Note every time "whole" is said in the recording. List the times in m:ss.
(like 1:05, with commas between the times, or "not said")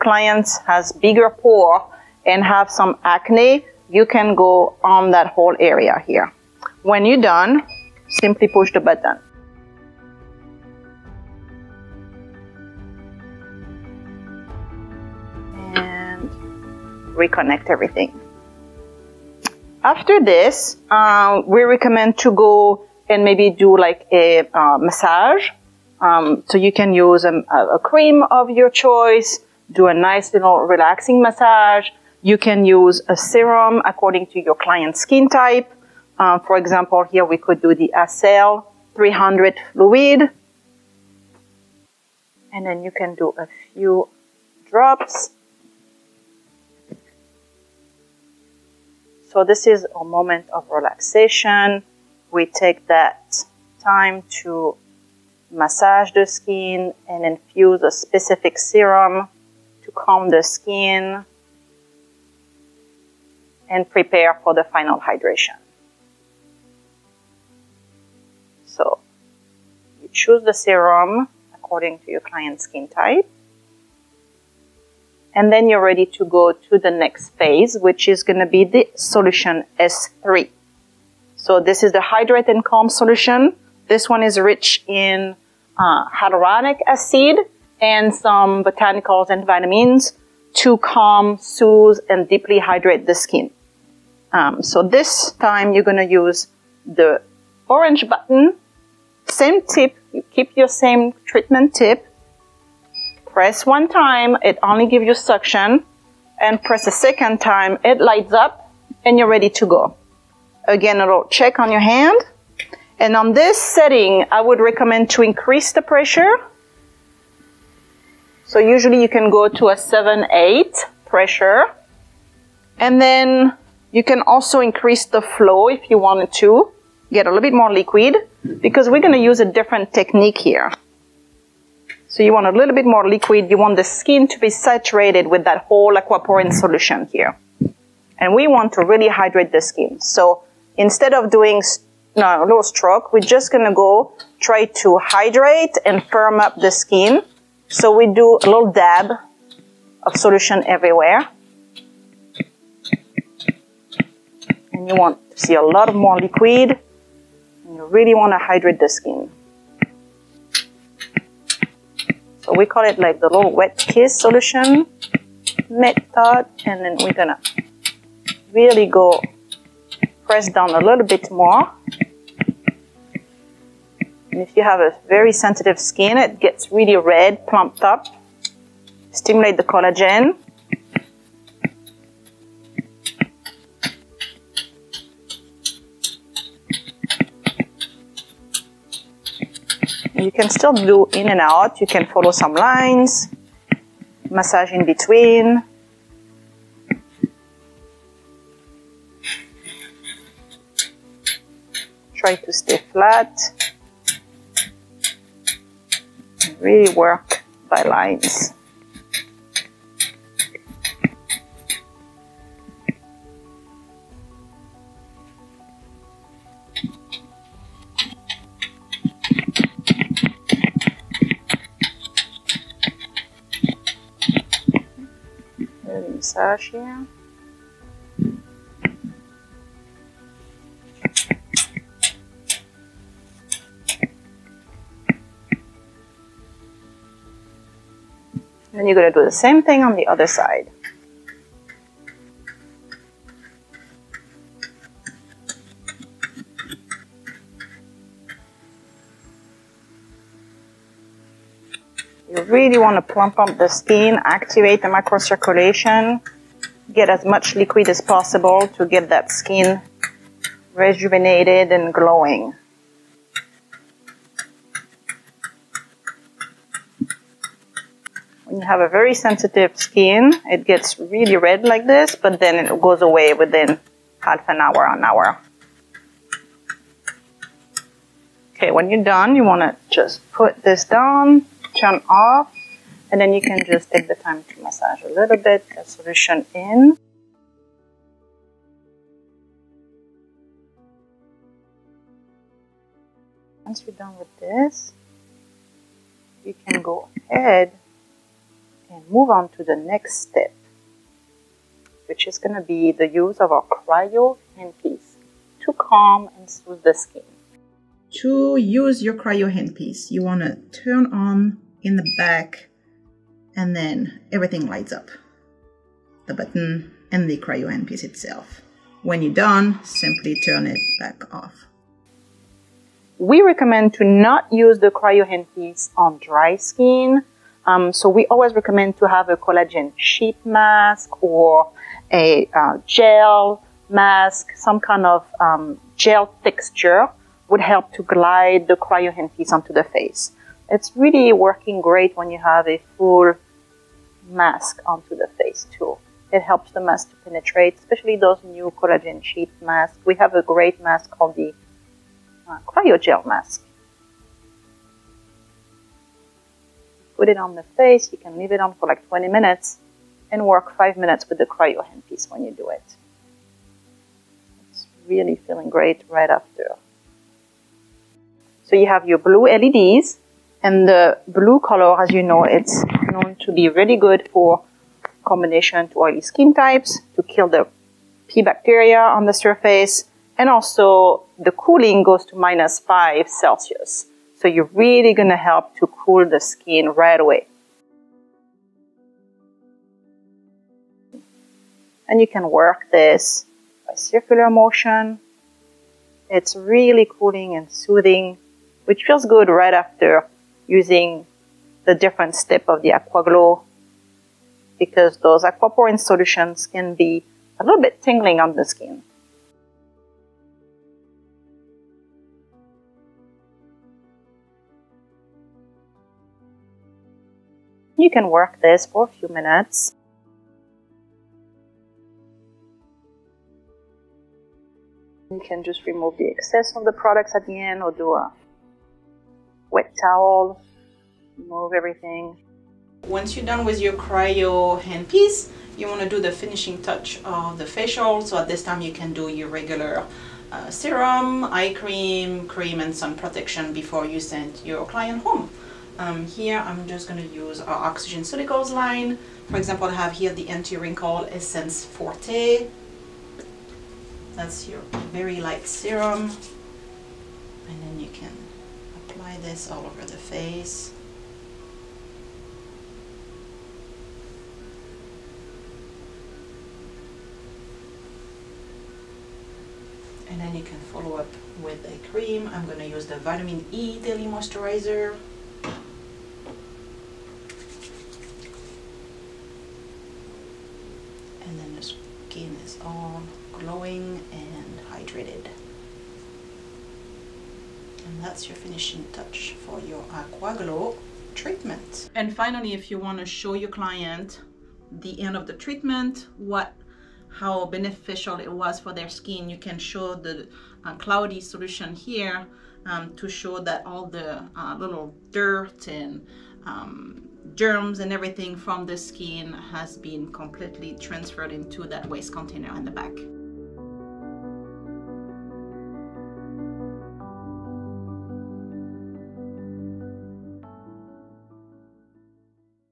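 0:05, 2:15.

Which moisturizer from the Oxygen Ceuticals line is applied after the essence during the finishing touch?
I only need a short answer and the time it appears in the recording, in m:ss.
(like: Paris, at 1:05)
Vitamin E Daily Moisturizer, at 7:53.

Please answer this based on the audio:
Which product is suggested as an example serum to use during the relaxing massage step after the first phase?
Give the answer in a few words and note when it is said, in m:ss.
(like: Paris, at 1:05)
Acel 300 fluid, at 0:37.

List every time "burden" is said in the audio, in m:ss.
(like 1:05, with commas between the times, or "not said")
not said.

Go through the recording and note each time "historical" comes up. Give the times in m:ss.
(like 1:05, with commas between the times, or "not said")
not said.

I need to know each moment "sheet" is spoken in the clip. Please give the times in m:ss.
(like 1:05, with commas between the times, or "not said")
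5:29, 5:49.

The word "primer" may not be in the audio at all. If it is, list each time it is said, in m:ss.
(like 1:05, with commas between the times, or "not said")
not said.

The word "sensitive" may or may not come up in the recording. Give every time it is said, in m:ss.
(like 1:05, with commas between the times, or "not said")
2:55, 4:29.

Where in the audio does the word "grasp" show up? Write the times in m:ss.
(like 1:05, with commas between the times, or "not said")
not said.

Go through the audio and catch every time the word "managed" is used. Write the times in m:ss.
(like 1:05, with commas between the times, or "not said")
not said.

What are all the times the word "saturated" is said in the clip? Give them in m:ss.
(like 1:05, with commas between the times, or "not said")
2:14.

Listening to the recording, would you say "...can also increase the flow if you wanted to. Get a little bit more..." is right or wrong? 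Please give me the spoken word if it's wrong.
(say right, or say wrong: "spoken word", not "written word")
right.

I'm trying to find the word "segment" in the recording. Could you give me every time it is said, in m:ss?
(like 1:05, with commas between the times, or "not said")
not said.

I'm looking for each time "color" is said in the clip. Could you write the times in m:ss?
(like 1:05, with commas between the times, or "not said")
6:11.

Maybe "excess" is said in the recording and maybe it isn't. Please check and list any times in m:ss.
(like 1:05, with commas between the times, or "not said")
7:06.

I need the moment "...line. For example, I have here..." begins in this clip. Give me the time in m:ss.
7:28.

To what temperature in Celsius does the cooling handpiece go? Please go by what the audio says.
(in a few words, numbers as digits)
-5.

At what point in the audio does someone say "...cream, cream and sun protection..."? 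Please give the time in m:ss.
7:21.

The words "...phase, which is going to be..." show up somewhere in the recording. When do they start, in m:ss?
1:17.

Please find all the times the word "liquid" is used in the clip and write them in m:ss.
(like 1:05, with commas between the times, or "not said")
2:07, 2:13, 2:36, 4:17.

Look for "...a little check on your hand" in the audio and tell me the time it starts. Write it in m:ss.
1:51.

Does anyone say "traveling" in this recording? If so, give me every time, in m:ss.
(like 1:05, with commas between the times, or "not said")
not said.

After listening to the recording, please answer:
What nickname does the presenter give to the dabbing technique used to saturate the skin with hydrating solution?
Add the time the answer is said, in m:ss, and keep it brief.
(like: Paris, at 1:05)
wet kiss, at 2:43.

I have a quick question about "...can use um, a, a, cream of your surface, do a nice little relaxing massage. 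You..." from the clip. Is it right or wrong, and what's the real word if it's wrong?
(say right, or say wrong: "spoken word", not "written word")
wrong: "choice", not "surface".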